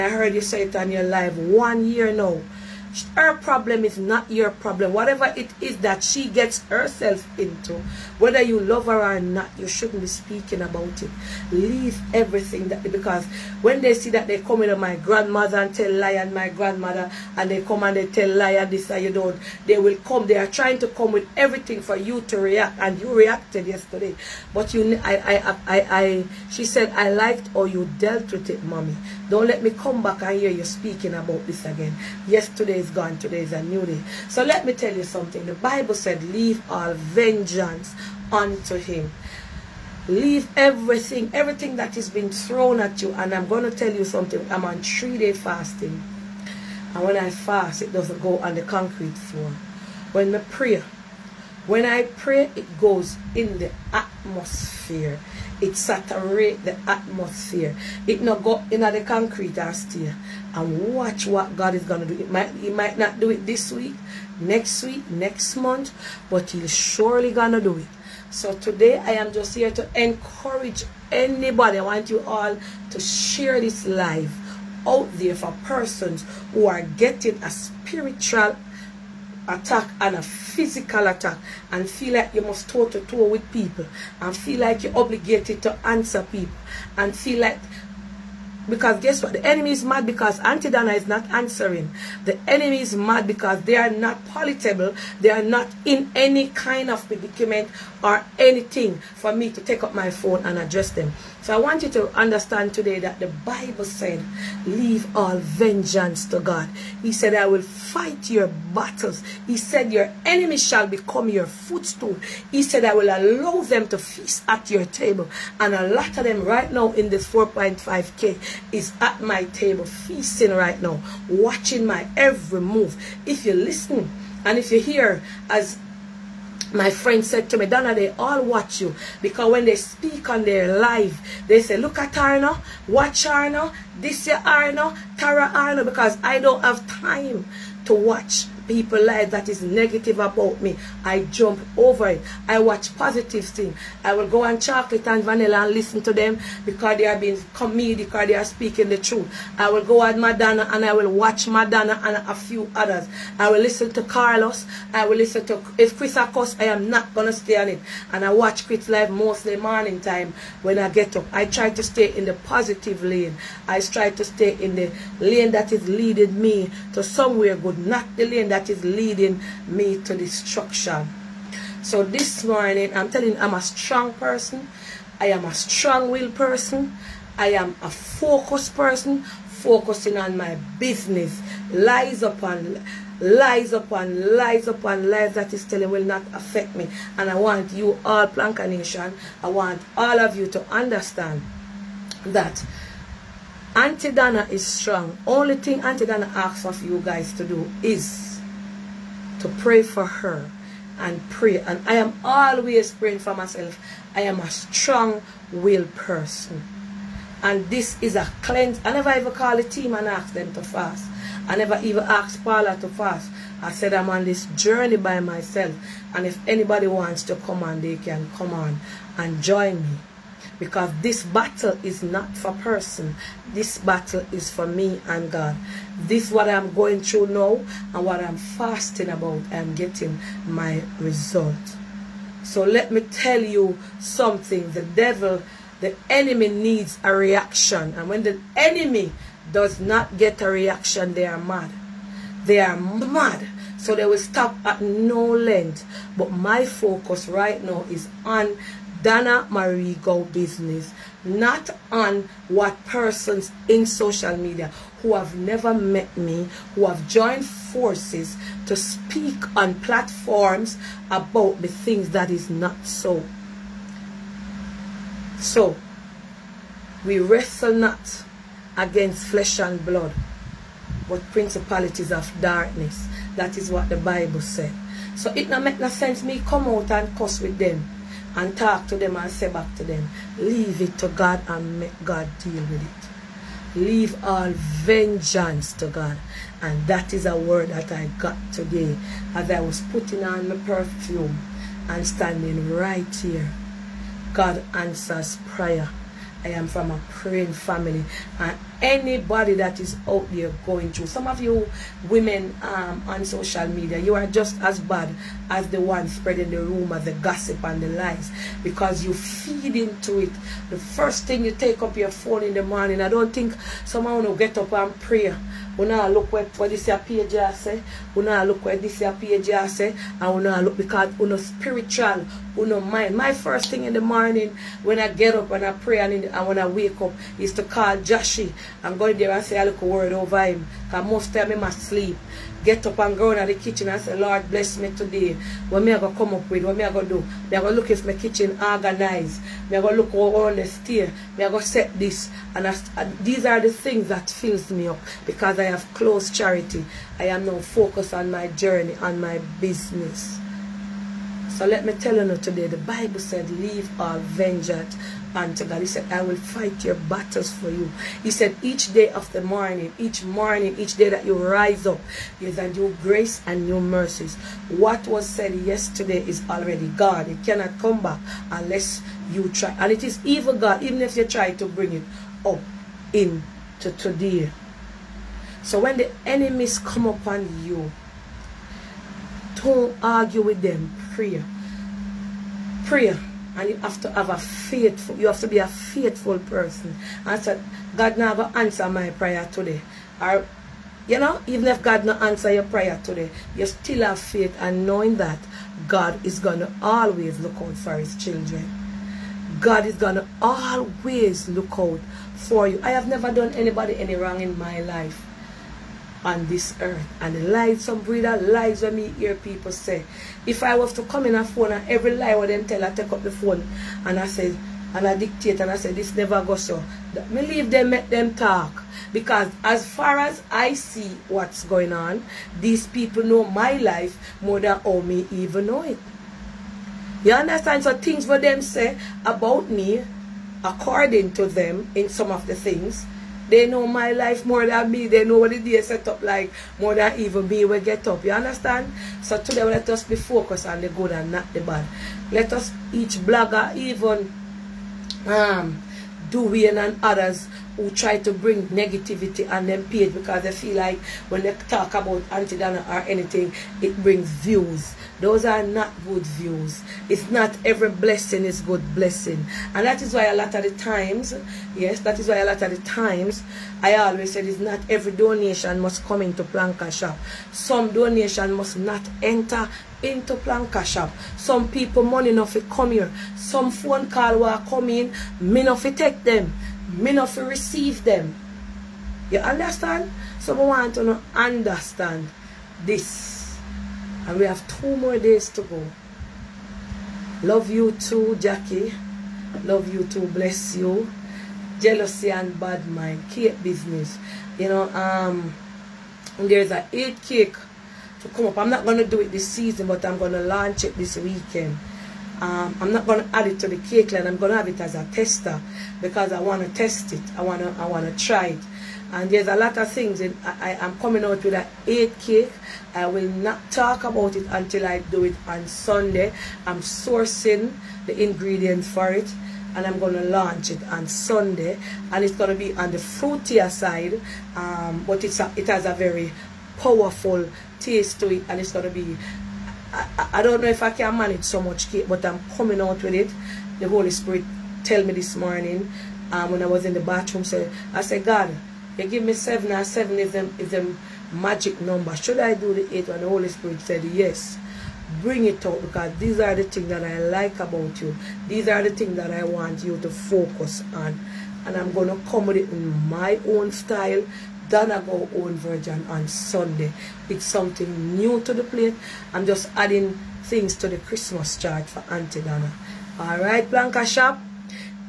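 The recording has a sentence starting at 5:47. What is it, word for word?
I am now focused on my journey, on my business.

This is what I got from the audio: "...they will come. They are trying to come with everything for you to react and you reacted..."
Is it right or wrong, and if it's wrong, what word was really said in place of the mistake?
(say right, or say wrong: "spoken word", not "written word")
right.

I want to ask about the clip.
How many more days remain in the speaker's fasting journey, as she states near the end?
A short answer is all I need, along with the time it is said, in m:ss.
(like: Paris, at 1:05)
2, at 8:04.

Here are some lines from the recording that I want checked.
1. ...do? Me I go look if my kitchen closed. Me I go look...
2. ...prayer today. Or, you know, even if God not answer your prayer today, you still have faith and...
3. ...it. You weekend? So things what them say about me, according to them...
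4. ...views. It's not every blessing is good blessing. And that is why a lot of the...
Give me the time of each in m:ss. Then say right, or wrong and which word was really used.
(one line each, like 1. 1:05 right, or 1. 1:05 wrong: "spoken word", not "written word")
1. 5:37 wrong: "organized", not "closed"
2. 6:29 right
3. 7:05 wrong: "understand", not "weekend"
4. 7:36 right.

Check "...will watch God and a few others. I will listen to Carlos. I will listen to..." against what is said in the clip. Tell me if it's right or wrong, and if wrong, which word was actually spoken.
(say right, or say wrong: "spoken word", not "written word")
wrong: "Madonna", not "God".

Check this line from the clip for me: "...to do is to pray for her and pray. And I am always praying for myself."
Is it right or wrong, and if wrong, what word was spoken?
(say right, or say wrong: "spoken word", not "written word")
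right.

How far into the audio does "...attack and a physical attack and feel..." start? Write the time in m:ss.
1:19.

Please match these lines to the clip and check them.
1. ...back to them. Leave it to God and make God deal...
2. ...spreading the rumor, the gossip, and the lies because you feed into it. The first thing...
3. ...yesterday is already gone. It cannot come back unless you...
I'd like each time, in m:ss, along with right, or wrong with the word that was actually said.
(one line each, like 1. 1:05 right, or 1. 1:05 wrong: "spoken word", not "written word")
1. 4:39 right
2. 5:06 right
3. 6:05 right.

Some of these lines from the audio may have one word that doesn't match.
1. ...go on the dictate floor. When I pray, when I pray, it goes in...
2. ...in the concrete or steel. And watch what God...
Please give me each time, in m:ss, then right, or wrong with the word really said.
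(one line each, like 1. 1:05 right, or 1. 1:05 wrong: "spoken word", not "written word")
1. 0:48 wrong: "concrete", not "dictate"
2. 0:58 right.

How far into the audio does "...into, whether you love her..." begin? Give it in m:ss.
0:07.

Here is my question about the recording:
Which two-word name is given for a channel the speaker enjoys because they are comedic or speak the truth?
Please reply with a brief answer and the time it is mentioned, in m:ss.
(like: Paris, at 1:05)
Chocolate and Vanilla, at 2:24.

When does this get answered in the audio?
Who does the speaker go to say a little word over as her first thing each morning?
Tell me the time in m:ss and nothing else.
5:27.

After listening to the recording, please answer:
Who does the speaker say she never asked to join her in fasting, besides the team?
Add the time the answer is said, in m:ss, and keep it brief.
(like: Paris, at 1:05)
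Paula, at 3:32.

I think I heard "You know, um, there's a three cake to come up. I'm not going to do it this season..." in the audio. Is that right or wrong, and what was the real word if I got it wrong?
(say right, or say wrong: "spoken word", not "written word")
wrong: "eight", not "three".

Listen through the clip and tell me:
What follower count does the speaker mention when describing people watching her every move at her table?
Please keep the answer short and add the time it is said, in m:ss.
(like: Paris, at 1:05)
4.5K, at 1:57.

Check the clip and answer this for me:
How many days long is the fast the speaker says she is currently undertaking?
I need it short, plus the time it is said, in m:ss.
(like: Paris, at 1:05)
3, at 0:44.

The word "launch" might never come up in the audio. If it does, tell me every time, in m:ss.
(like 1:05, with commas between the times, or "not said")
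8:20, 8:40.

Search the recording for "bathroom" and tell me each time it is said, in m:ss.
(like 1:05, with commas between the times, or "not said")
8:57.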